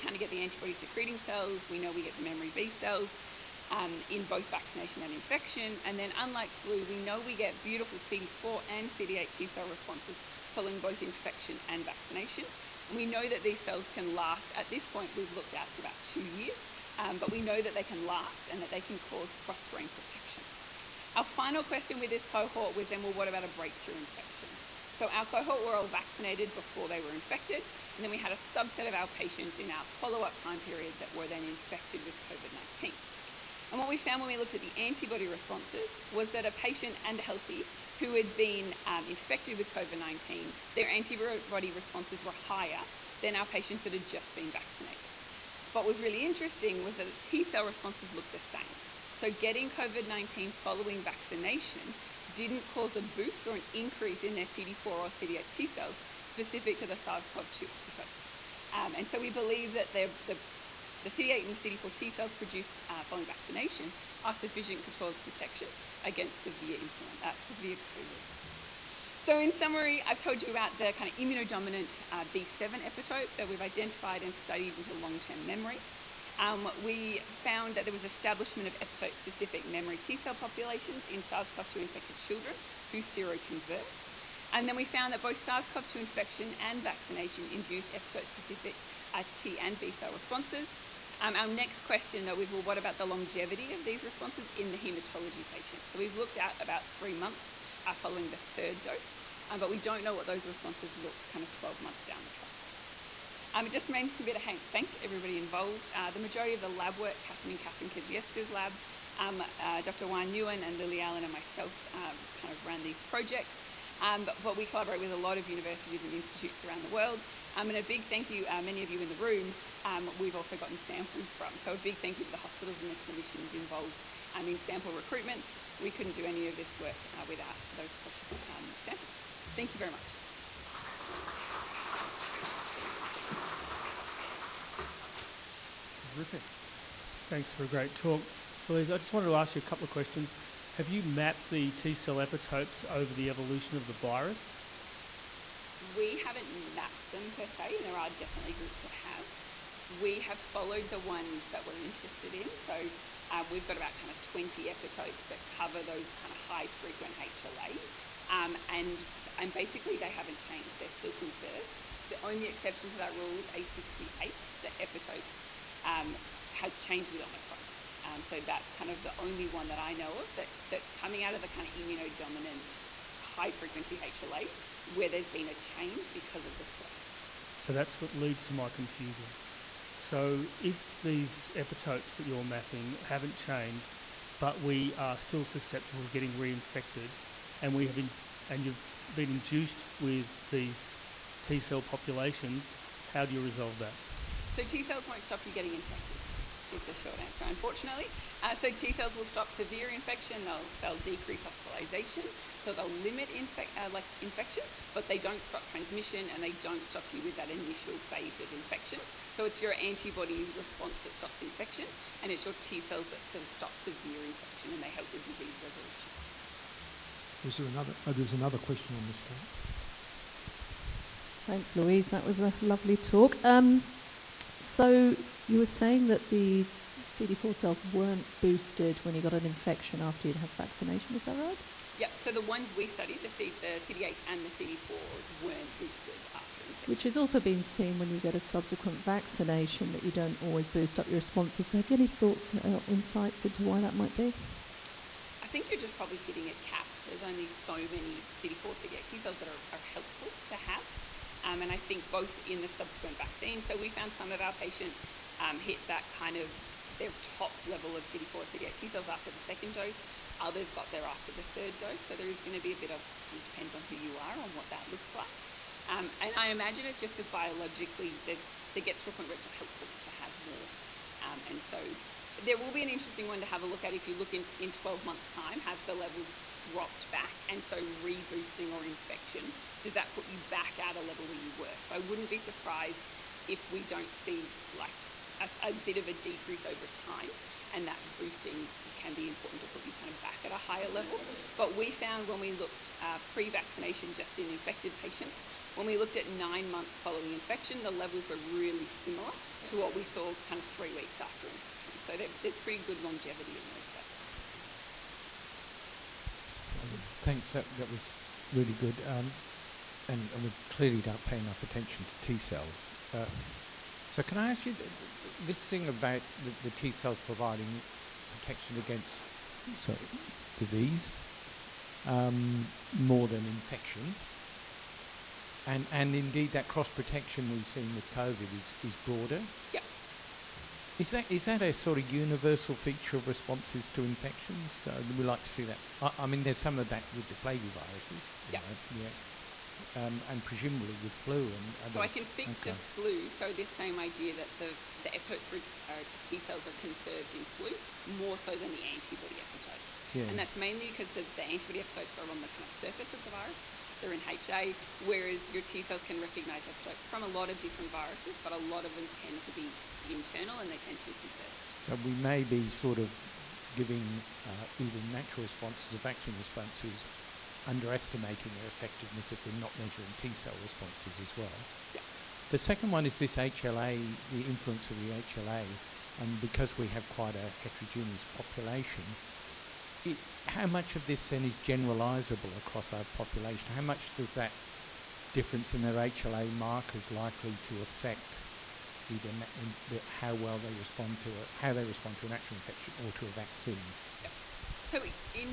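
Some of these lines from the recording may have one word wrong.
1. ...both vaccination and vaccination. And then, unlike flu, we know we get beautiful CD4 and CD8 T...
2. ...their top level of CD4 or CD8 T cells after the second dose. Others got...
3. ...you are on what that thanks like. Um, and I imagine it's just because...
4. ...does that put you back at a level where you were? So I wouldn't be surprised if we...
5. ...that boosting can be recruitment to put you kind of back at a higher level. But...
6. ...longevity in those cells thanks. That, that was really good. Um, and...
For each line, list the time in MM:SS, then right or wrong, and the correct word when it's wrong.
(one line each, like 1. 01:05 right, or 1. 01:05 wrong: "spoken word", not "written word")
1. 00:04 wrong: "infection", not "vaccination"
2. 04:16 right
3. 04:23 wrong: "looks", not "thanks"
4. 04:39 right
5. 04:47 wrong: "important", not "recruitment"
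6. 05:03 right.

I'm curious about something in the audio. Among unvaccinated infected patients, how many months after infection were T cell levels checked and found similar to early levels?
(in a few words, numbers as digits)
9 months.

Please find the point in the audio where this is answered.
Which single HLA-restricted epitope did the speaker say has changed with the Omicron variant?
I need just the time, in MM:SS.
02:43.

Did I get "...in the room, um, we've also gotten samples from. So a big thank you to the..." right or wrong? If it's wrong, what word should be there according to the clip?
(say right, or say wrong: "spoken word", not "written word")
right.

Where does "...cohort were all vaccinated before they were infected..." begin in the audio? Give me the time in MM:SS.
00:25.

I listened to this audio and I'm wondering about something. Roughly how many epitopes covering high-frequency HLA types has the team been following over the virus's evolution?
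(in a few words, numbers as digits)
About 20.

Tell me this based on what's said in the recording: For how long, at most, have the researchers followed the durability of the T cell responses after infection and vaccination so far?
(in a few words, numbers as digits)
2 years.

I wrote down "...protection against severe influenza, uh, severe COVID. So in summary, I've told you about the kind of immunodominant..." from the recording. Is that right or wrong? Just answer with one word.
right.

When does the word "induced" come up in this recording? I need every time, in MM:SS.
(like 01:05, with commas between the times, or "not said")
01:27, 03:09.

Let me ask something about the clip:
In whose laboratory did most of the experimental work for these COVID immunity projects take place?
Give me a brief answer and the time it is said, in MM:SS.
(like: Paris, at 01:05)
Katherine Kedzierska's lab, at 01:47.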